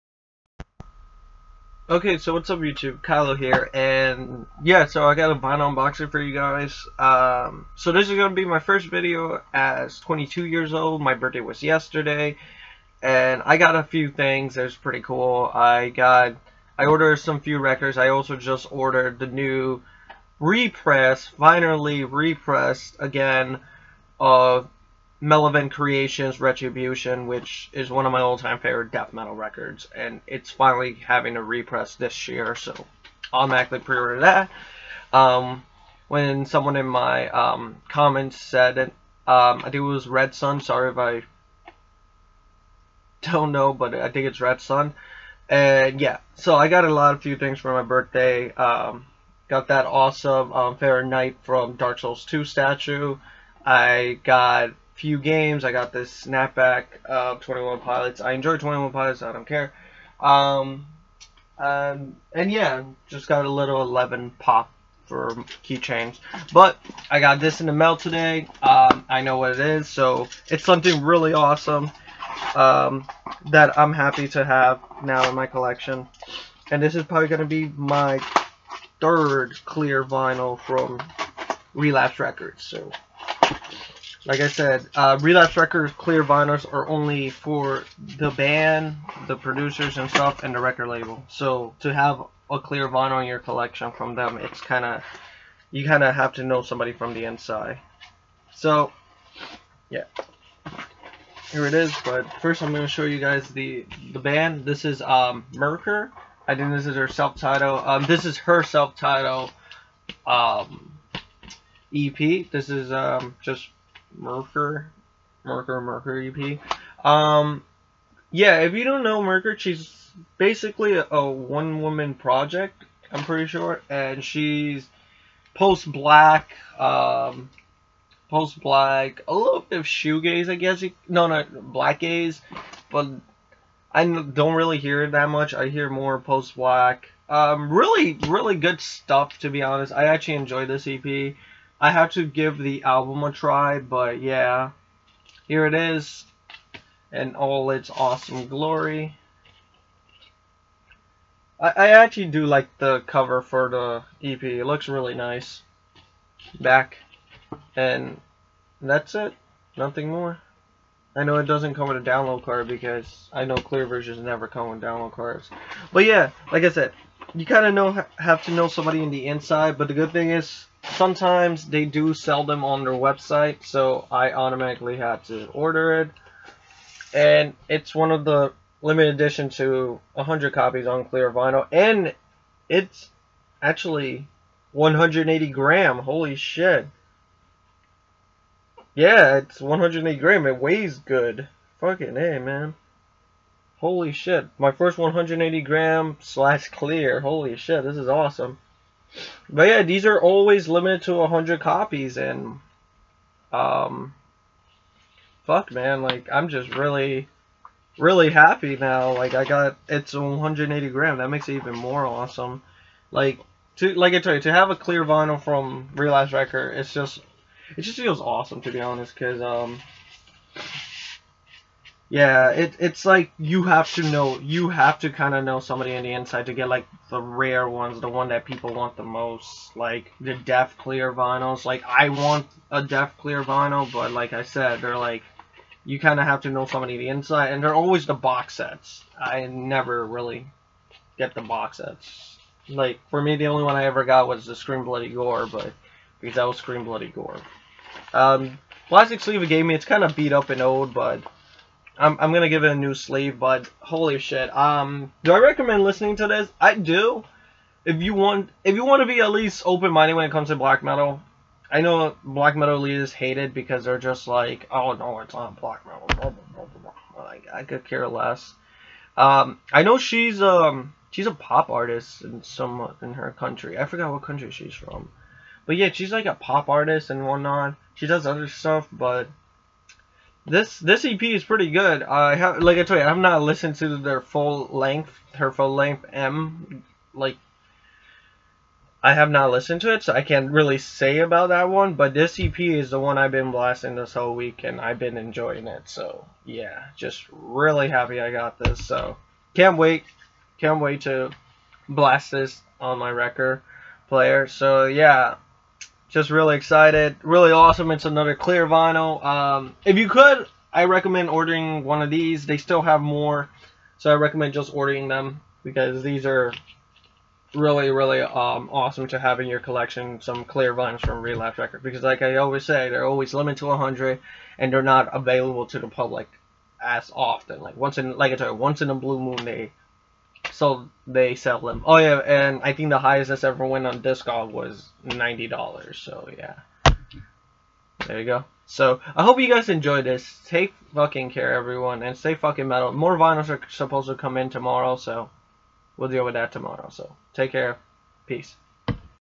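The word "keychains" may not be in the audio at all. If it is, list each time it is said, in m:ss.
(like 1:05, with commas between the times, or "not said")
1:05.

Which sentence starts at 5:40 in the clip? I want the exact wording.
Take fucking care, everyone, and stay fucking metal.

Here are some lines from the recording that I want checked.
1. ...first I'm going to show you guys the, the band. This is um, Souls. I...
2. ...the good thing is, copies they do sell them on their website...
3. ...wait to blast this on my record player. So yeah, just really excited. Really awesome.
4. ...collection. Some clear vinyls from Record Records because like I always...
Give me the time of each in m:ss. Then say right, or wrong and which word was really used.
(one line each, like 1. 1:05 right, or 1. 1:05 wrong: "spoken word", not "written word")
1. 1:42 wrong: "Myrkur", not "Souls"
2. 2:49 wrong: "sometimes", not "copies"
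3. 5:00 right
4. 5:19 wrong: "Relapse", not "Record".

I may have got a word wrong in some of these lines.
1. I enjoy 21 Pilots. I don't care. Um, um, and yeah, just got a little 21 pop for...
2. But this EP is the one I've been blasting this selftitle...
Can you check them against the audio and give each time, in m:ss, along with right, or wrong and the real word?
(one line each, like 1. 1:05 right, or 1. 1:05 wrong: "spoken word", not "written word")
1. 0:58 wrong: "11", not "21"
2. 4:51 wrong: "whole", not "selftitle".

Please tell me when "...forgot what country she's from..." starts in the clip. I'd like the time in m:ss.
4:33.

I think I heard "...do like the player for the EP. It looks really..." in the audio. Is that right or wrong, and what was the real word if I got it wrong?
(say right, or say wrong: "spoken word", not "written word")
wrong: "cover", not "player".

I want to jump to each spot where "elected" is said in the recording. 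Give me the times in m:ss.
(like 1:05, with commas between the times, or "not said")
not said.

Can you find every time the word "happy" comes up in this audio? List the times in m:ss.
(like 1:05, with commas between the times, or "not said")
1:13, 3:28, 4:57.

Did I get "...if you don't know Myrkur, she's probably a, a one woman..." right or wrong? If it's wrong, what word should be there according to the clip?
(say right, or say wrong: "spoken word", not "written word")
wrong: "basically", not "probably".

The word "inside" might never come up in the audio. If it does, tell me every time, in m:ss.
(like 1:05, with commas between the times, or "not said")
1:37, 2:49, 3:46, 3:57.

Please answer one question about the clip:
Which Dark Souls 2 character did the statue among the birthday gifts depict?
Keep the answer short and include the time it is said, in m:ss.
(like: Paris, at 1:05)
Fair Knight, at 0:50.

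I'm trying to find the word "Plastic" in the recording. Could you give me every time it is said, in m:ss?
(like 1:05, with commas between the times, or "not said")
4:08.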